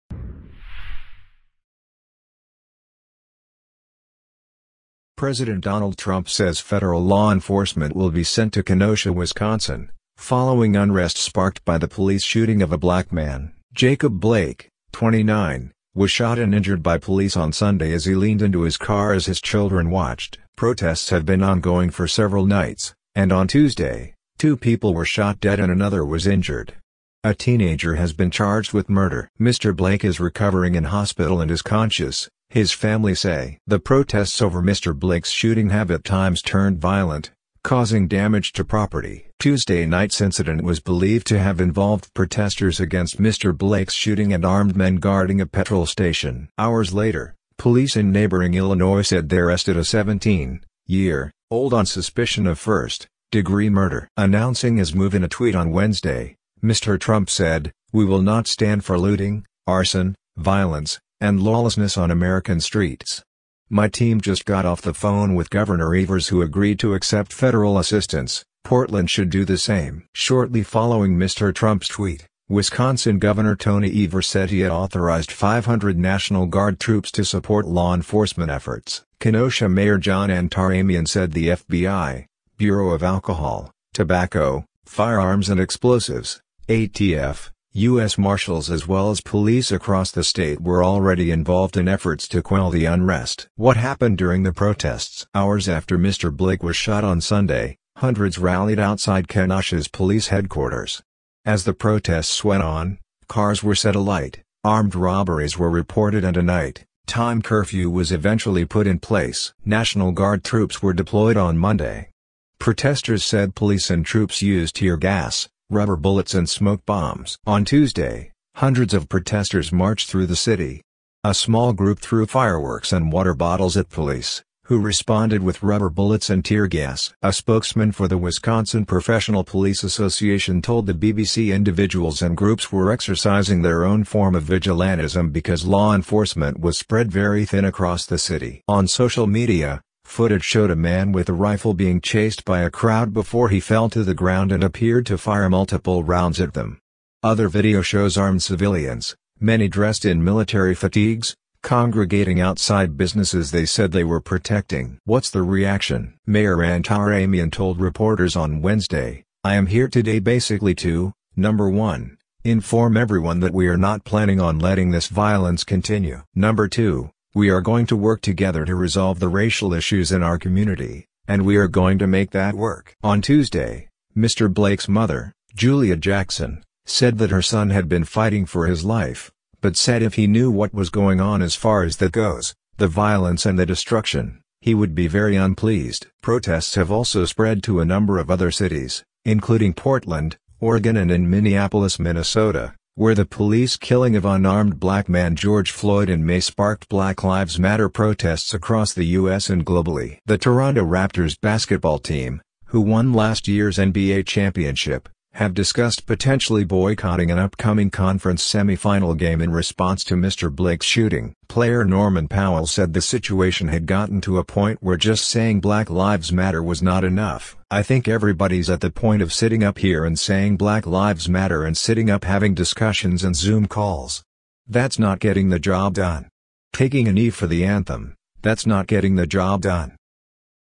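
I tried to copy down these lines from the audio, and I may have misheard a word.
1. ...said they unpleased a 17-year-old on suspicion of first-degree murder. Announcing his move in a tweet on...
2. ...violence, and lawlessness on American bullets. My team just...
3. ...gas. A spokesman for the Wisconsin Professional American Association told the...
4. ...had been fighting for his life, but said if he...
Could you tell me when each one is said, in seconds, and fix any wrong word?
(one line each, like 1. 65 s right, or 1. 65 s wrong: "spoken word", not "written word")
1. 49 s wrong: "arrested", not "unpleased"
2. 60 s wrong: "streets", not "bullets"
3. 126 s wrong: "Police", not "American"
4. 177 s right.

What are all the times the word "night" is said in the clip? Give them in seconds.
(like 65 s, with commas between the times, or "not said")
22 s, 39 s, 106 s.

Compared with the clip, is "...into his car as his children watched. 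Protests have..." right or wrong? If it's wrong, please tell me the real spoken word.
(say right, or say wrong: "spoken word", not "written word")
right.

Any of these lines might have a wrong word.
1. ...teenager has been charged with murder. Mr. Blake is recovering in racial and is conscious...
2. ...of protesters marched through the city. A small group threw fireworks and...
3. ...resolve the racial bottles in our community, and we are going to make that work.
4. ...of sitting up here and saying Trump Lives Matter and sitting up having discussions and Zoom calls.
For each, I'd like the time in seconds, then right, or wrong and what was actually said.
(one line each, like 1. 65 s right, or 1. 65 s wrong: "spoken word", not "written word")
1. 27 s wrong: "hospital", not "racial"
2. 118 s right
3. 168 s wrong: "issues", not "bottles"
4. 219 s wrong: "Black", not "Trump".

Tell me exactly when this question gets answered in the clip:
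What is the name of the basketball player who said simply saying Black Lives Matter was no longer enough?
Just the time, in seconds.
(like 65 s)
211 s.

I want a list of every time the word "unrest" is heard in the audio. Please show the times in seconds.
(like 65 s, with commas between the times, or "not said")
10 s, 92 s.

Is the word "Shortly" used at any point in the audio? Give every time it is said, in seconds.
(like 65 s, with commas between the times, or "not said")
70 s.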